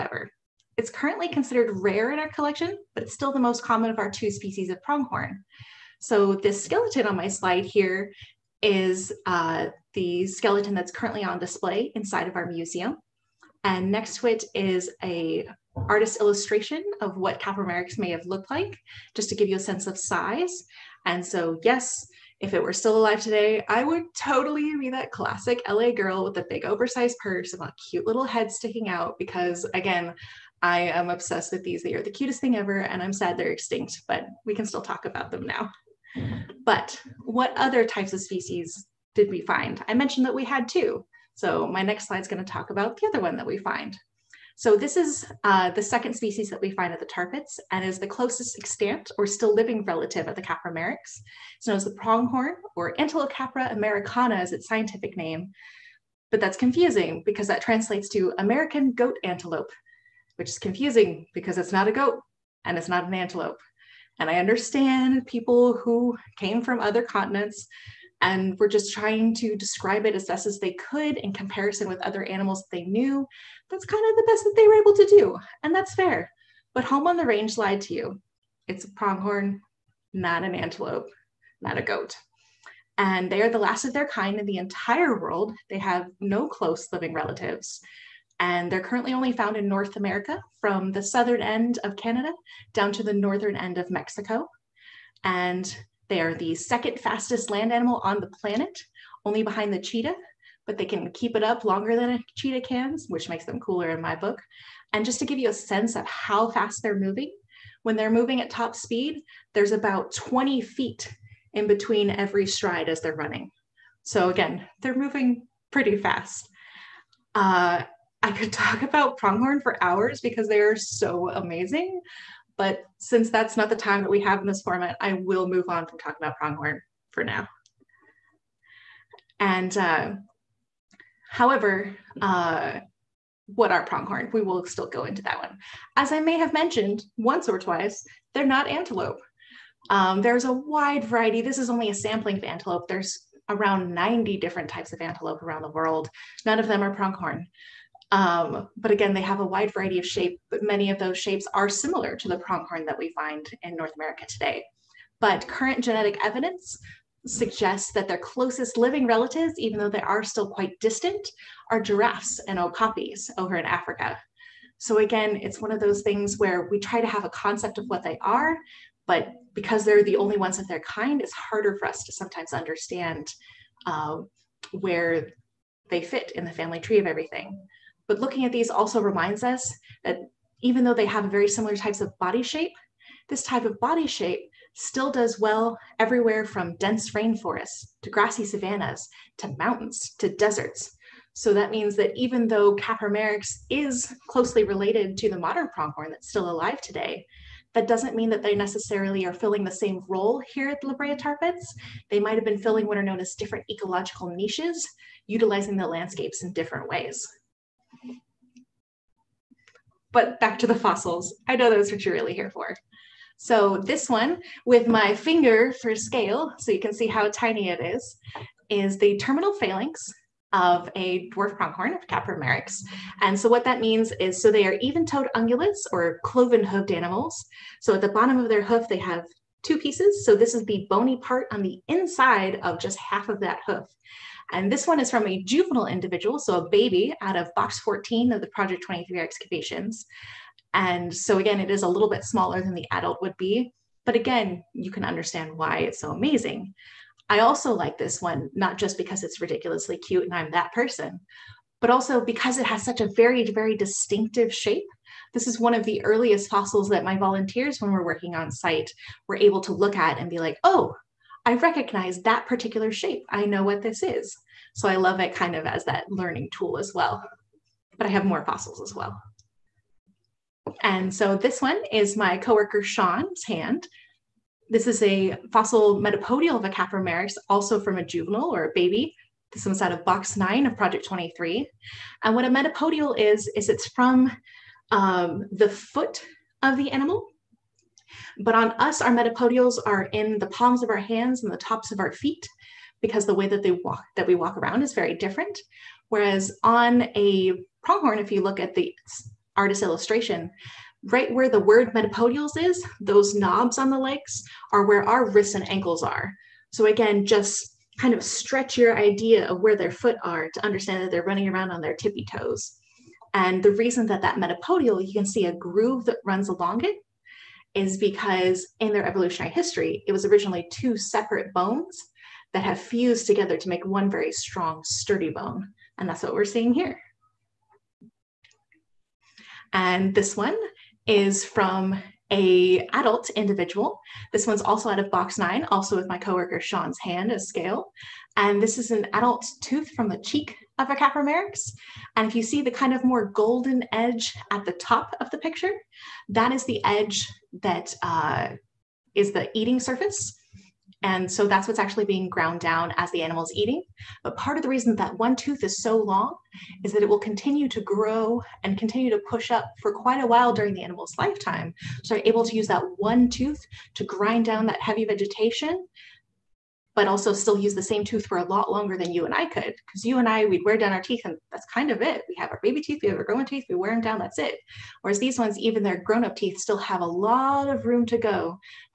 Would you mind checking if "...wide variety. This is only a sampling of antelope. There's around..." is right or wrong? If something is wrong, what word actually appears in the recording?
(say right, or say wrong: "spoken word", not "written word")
right.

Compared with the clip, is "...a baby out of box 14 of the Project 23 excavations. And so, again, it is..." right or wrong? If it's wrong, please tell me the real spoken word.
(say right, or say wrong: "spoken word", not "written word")
right.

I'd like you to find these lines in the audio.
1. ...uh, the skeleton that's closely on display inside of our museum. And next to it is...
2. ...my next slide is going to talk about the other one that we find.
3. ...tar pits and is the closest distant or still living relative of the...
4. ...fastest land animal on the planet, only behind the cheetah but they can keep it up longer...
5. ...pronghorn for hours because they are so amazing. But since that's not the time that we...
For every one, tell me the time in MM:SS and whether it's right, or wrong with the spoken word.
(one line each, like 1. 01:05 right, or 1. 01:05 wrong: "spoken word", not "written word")
1. 00:09 wrong: "currently", not "closely"
2. 00:41 right
3. 00:47 wrong: "extant", not "distant"
4. 01:36 right
5. 01:59 right.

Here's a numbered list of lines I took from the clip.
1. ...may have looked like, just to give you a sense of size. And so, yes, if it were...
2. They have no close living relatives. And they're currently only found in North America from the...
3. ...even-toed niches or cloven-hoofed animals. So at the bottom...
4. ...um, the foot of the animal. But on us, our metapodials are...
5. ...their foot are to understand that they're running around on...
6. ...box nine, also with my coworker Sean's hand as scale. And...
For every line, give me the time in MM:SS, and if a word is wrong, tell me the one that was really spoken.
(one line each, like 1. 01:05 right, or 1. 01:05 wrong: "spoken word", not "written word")
1. 00:17 right
2. 01:25 right
3. 03:44 wrong: "ungulates", not "niches"
4. 04:44 right
5. 05:09 right
6. 05:35 right.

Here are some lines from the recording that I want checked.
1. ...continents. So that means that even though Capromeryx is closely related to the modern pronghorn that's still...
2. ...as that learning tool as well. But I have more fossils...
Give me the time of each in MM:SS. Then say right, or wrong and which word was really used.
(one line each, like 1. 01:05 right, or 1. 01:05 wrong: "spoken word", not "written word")
1. 03:10 wrong: "deserts", not "continents"
2. 04:25 right.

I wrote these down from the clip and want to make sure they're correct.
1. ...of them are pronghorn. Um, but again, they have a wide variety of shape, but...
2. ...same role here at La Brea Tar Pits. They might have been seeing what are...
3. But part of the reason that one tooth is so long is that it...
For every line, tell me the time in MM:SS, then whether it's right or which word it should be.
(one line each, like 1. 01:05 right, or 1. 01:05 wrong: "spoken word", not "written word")
1. 02:26 right
2. 03:19 wrong: "filling", not "seeing"
3. 05:54 right.